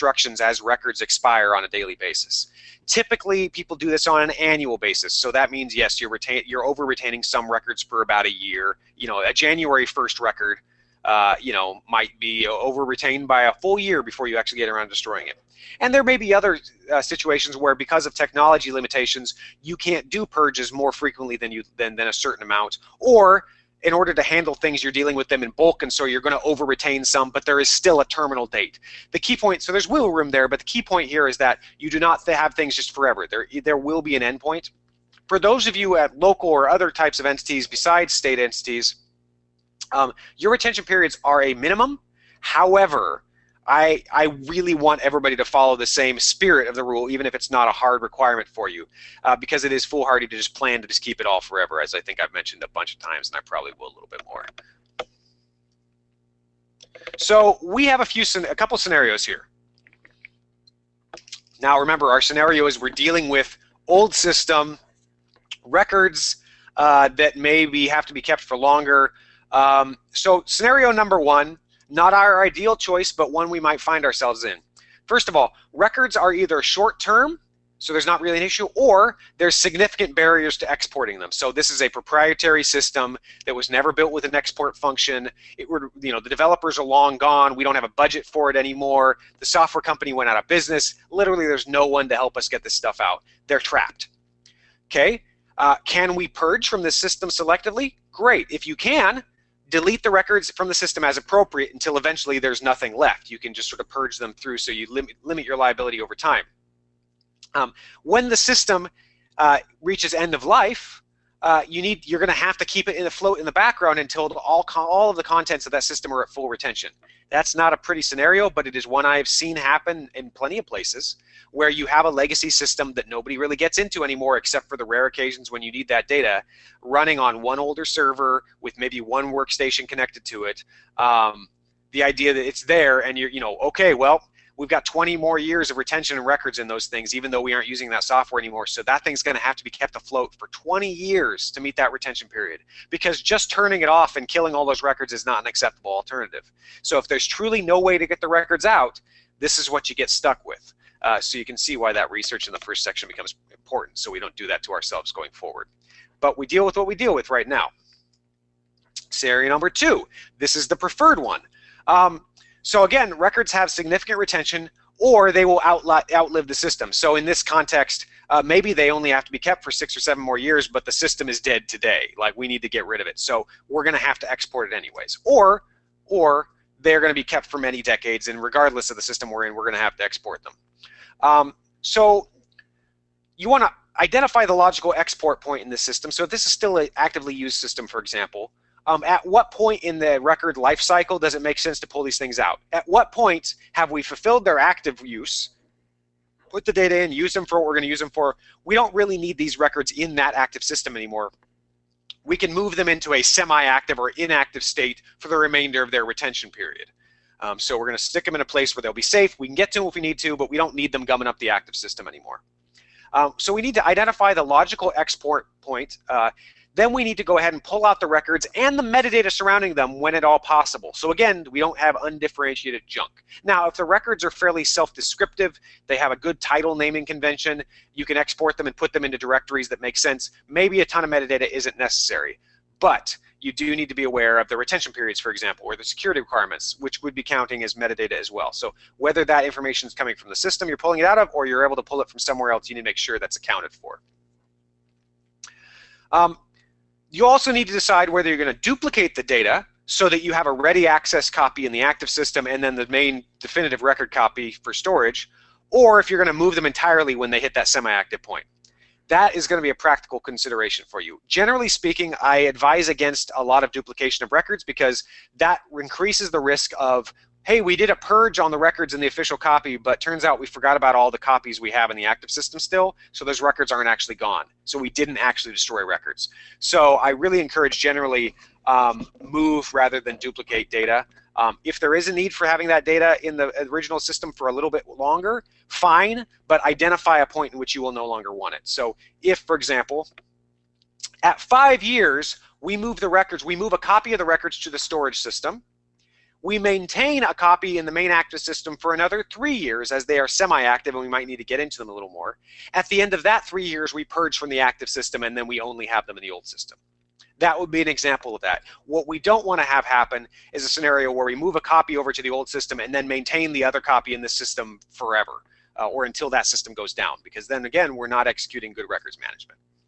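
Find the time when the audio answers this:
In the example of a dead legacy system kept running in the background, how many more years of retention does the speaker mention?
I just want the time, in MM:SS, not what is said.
02:14.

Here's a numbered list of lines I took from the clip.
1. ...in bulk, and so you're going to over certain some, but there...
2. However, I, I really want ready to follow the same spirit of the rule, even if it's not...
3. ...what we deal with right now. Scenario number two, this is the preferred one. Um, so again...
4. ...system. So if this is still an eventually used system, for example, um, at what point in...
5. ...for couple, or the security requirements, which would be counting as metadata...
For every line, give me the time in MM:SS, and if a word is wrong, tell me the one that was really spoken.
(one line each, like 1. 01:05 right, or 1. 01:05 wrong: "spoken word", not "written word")
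1. 00:25 wrong: "retain", not "certain"
2. 00:42 wrong: "everybody", not "ready"
3. 02:36 right
4. 03:05 wrong: "actively", not "eventually"
5. 03:55 wrong: "example", not "couple".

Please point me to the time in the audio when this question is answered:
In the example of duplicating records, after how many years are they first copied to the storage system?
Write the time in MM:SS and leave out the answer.
04:51.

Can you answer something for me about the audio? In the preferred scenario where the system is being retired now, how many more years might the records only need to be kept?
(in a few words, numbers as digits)
6 or 7.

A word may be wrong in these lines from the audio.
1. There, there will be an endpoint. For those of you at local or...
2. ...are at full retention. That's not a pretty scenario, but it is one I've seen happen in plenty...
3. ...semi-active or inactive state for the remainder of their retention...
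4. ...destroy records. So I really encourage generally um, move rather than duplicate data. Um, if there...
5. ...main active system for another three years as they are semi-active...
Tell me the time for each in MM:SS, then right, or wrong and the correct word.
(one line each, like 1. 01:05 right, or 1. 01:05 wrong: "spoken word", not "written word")
1. 00:33 right
2. 01:56 right
3. 03:23 right
4. 04:35 right
5. 04:57 right.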